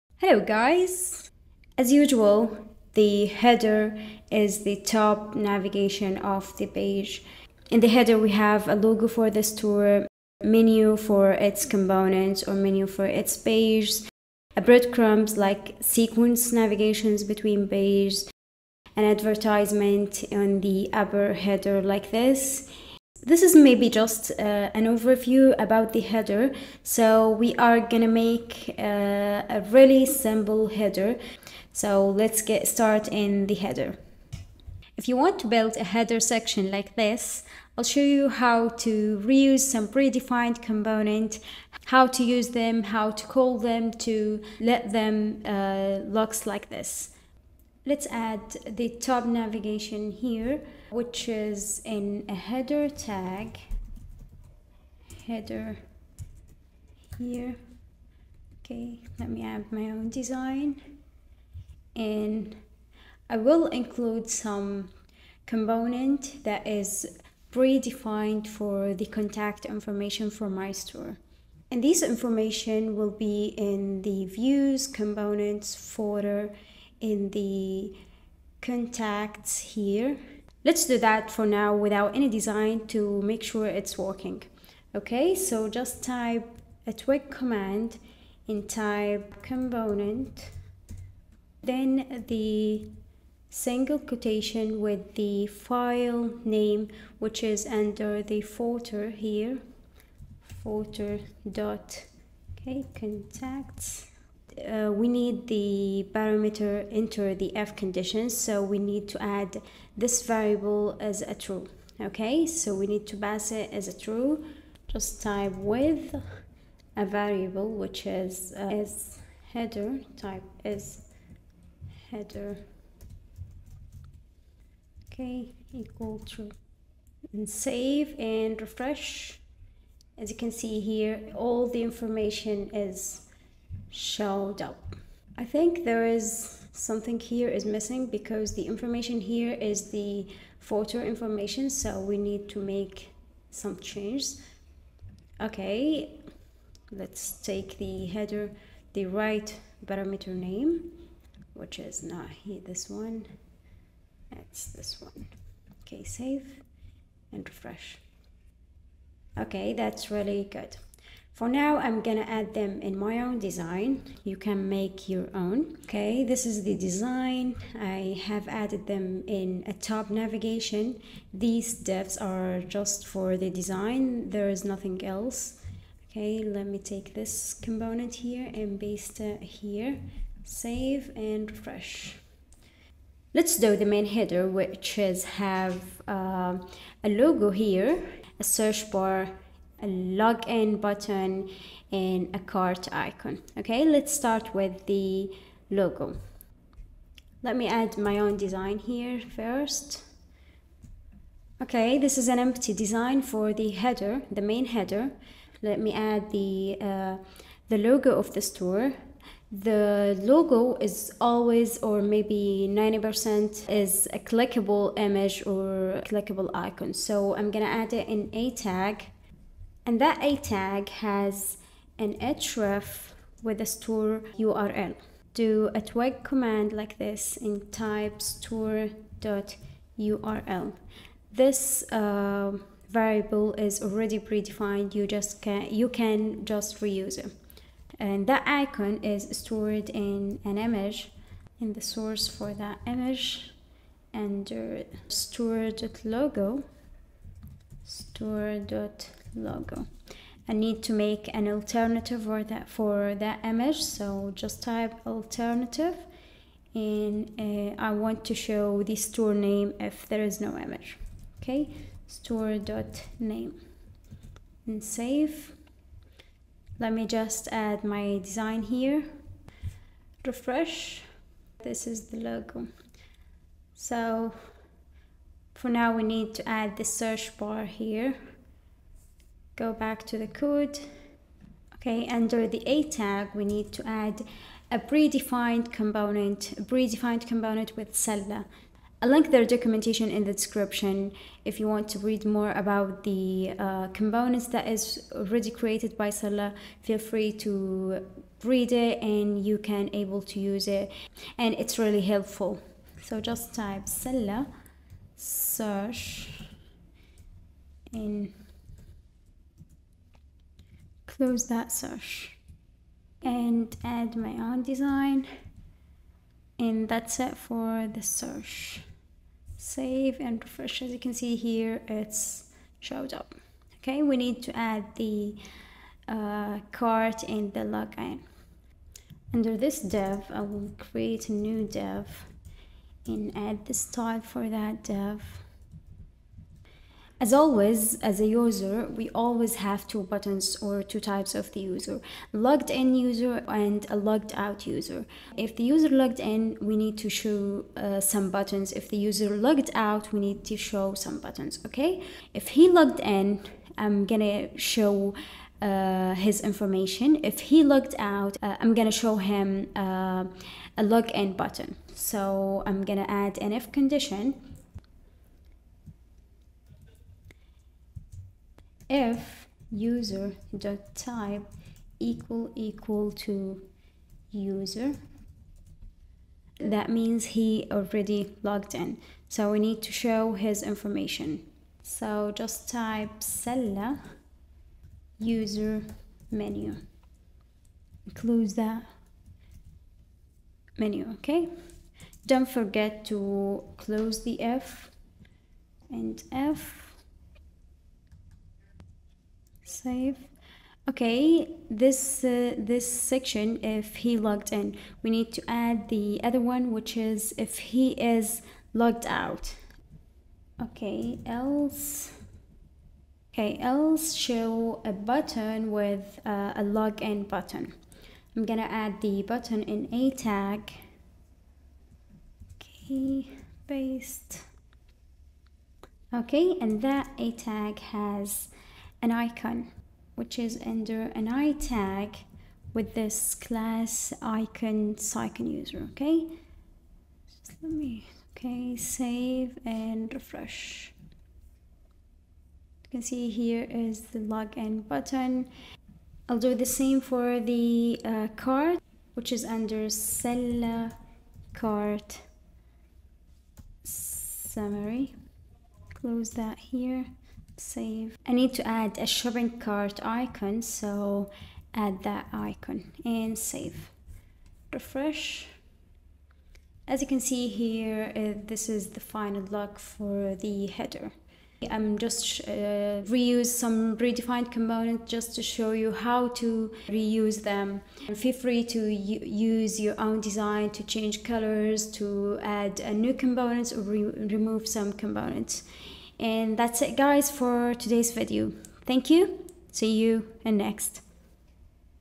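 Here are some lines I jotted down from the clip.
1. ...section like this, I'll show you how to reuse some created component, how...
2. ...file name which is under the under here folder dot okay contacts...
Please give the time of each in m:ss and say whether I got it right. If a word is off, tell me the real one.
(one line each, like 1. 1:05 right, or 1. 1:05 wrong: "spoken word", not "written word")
1. 0:36 wrong: "predefined", not "created"
2. 1:35 wrong: "folder", not "under".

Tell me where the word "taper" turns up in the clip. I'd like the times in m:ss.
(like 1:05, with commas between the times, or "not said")
not said.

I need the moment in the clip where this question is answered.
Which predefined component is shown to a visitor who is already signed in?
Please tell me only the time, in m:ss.
6:23.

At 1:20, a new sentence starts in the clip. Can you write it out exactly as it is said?
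Let's do that for now without any design to make sure it's working.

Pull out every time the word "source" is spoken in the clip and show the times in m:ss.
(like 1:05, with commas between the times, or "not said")
4:01.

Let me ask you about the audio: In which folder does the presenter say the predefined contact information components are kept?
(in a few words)
views, components.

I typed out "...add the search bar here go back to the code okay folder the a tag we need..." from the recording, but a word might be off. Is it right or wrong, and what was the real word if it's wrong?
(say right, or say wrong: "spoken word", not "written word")
wrong: "under", not "folder".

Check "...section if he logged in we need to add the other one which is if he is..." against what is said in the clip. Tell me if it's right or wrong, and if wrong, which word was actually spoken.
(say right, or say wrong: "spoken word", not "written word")
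right.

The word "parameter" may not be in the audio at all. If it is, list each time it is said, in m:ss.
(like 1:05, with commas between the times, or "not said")
1:46, 2:29.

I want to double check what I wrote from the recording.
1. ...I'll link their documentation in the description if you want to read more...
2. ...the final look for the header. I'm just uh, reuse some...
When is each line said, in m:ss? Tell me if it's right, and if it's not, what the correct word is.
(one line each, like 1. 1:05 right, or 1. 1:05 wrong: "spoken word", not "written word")
1. 4:49 right
2. 7:48 right.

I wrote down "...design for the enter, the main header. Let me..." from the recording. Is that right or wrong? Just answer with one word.
wrong.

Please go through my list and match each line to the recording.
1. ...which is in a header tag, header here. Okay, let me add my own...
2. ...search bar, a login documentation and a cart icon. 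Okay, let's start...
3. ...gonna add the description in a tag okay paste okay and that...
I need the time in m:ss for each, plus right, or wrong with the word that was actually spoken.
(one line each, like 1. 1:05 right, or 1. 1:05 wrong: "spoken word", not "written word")
1. 0:50 right
2. 3:08 wrong: "button", not "documentation"
3. 6:58 wrong: "button", not "description".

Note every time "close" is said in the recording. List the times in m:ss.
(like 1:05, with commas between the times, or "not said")
5:11, 6:28, 6:33, 7:36.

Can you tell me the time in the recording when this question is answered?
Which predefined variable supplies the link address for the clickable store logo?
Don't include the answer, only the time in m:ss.
3:48.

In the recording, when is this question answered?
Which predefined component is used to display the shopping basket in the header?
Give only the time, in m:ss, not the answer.
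7:29.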